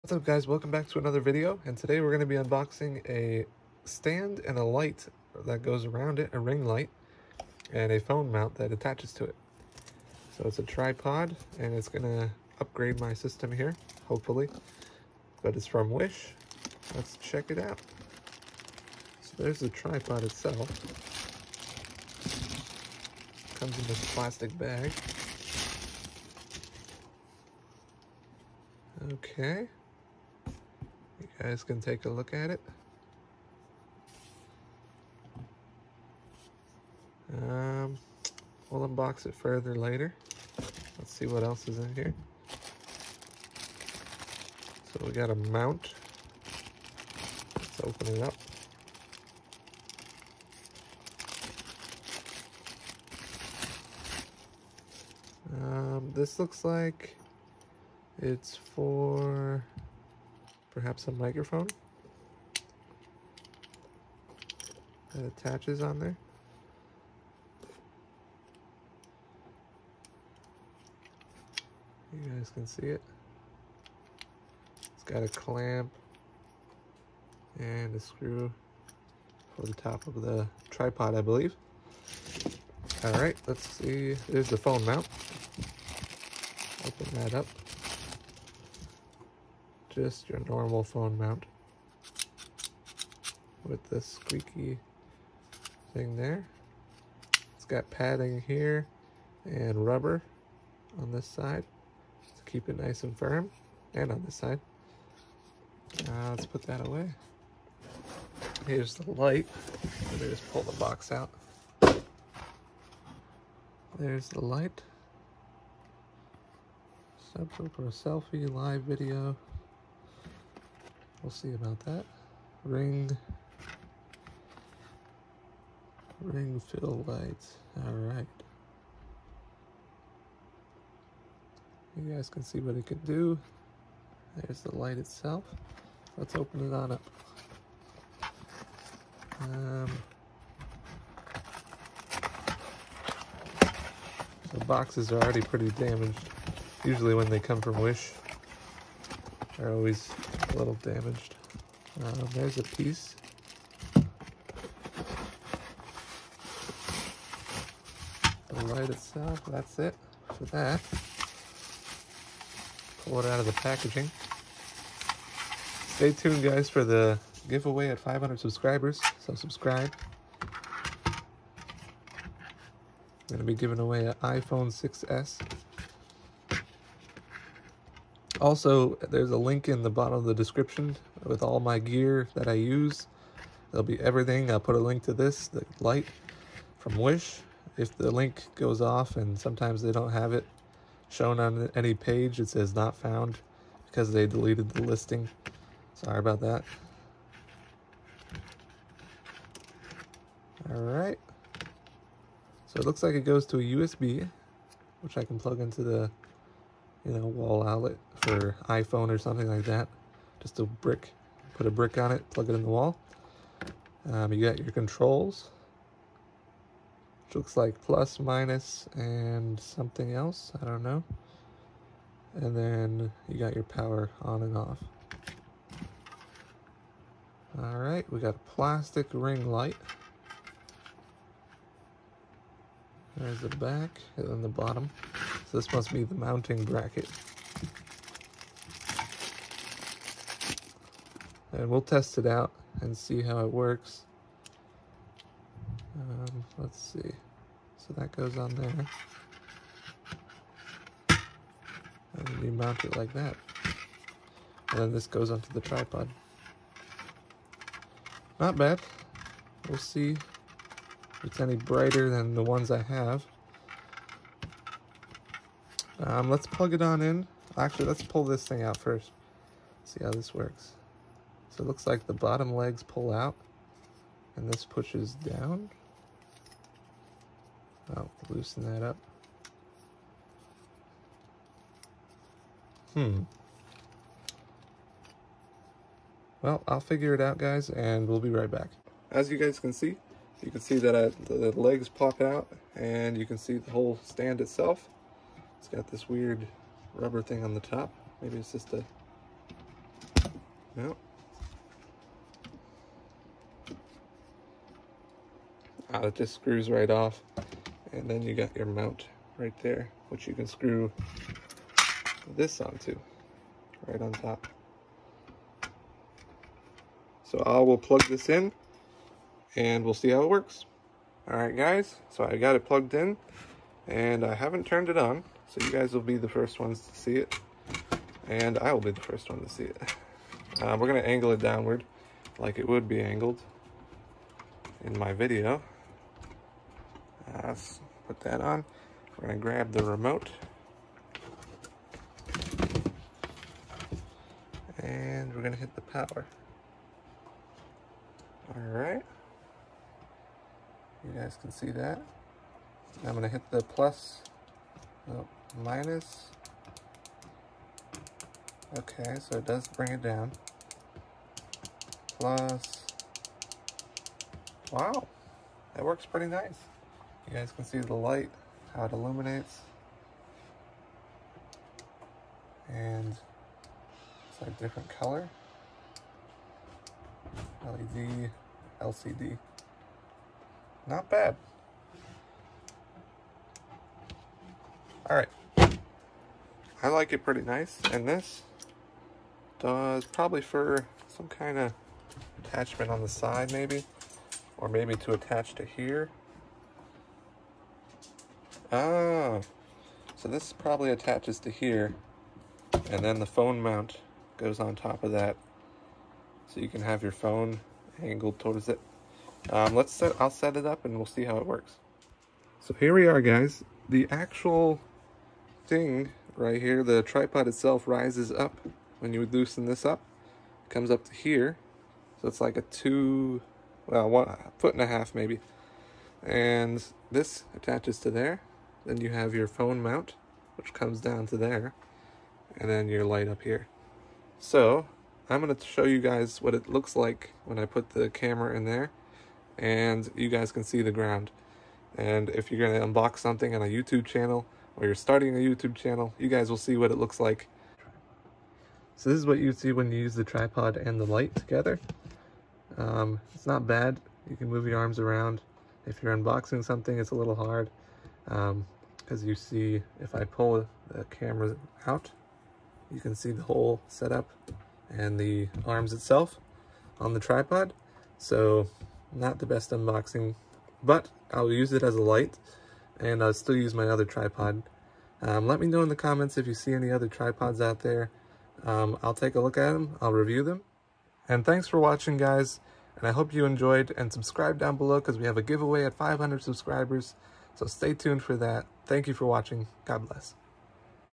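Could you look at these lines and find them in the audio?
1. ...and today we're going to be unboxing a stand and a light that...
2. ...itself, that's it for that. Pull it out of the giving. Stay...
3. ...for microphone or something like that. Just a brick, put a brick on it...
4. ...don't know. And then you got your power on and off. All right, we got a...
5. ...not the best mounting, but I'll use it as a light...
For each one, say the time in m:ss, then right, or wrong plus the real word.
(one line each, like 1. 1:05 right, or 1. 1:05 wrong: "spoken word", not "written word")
1. 0:01 right
2. 2:38 wrong: "packaging", not "giving"
3. 3:28 wrong: "iPhone", not "microphone"
4. 3:40 right
5. 7:49 wrong: "unboxing", not "mounting".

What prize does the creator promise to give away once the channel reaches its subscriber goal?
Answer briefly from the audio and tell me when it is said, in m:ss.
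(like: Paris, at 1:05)
iPhone 6S, at 2:54.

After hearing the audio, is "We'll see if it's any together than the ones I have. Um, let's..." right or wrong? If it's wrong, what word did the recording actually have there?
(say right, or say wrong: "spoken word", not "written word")
wrong: "brighter", not "together".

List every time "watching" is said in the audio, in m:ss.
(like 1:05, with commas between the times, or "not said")
8:01, 8:09.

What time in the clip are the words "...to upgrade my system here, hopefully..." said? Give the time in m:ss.
0:12.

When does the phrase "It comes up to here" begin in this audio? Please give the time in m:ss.
7:00.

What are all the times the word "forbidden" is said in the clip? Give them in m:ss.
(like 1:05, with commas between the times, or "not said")
not said.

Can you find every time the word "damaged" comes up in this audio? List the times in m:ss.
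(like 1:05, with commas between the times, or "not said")
2:25, 2:30.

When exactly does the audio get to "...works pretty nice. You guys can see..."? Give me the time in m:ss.
6:05.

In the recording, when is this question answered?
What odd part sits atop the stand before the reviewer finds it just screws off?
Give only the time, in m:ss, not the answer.
4:56.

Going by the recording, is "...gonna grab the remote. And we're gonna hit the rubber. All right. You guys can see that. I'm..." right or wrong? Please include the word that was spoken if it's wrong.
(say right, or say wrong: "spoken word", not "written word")
wrong: "power", not "rubber".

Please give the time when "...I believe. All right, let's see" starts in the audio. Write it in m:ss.
1:21.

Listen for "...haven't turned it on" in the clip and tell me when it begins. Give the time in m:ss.
5:24.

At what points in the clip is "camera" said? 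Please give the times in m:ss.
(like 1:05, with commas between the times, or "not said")
7:18, 7:41.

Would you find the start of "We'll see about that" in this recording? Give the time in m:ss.
2:01.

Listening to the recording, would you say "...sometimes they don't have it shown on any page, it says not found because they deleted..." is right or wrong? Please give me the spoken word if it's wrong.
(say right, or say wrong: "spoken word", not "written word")
right.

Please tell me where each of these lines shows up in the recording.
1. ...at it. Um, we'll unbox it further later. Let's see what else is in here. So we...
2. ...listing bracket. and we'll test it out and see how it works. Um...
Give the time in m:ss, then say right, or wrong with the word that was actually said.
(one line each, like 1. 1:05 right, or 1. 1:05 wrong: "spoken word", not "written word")
1. 0:32 right
2. 3:56 wrong: "mounting", not "listing".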